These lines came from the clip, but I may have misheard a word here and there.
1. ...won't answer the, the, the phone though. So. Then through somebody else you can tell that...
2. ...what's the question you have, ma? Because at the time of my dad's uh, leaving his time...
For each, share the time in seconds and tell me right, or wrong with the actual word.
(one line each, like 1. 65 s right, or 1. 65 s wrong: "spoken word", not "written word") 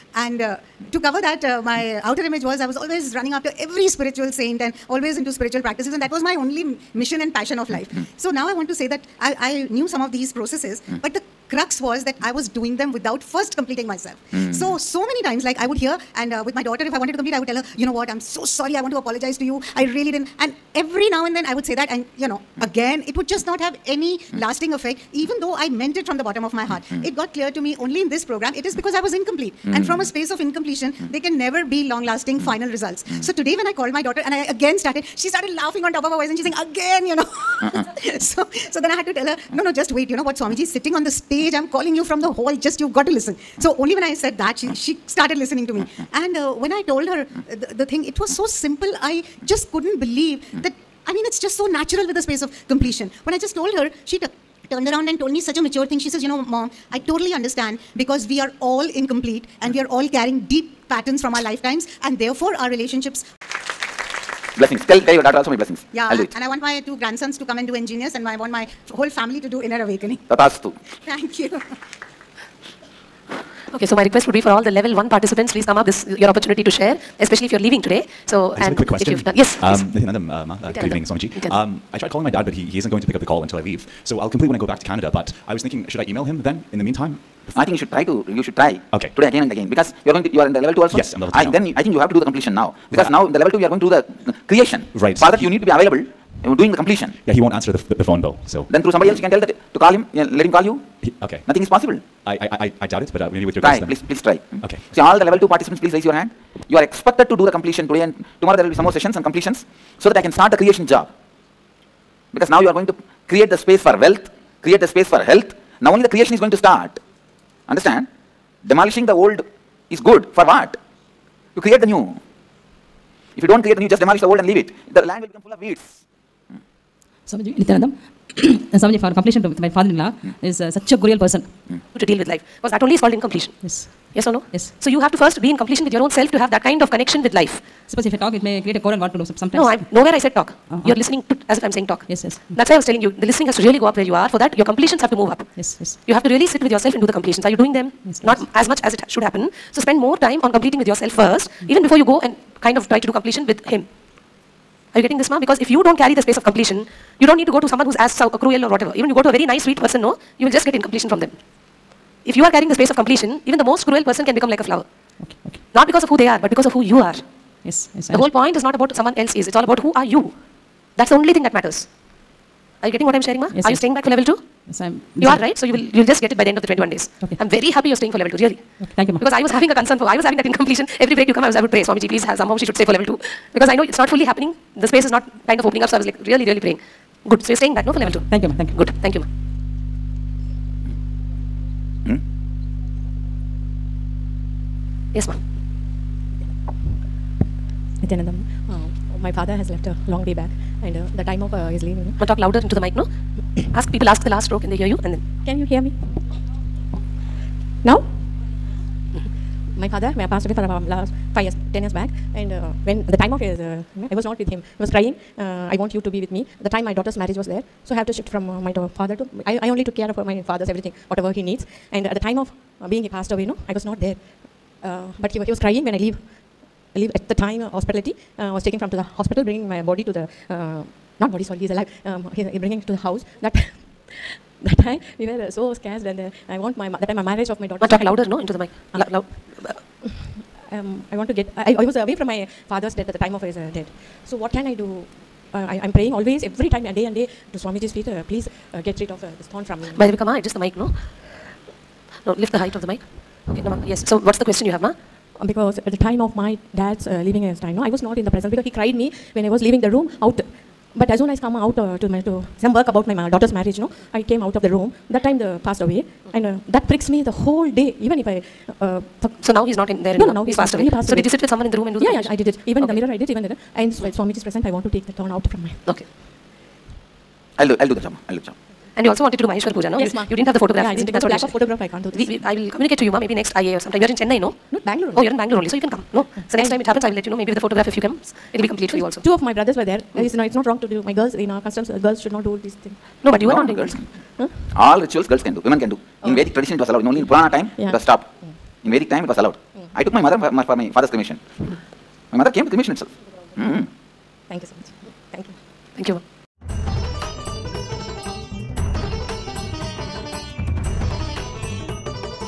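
1. 97 s right
2. 254 s right.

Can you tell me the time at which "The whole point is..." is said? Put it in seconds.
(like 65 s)
168 s.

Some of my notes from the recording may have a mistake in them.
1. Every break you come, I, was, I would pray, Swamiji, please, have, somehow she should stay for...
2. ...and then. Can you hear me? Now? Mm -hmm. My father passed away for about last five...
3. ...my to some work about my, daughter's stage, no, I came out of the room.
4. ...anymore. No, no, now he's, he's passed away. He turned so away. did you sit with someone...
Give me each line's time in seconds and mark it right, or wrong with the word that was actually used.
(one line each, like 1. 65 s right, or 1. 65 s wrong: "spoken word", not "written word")
1. 180 s right
2. 205 s right
3. 262 s wrong: "marriage", not "stage"
4. 270 s wrong: "passed", not "turned".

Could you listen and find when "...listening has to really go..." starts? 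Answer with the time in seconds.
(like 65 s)
143 s.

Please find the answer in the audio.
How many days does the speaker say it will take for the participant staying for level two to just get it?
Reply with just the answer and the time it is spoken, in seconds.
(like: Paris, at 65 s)
21, at 176 s.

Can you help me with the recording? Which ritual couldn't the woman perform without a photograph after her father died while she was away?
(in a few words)
Maheshwar Puja.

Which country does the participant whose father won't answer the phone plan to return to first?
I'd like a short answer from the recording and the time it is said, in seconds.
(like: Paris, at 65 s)
Canada, at 84 s.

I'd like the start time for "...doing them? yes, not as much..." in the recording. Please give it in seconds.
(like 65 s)
147 s.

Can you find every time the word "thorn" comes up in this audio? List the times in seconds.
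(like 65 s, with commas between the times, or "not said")
249 s, 275 s.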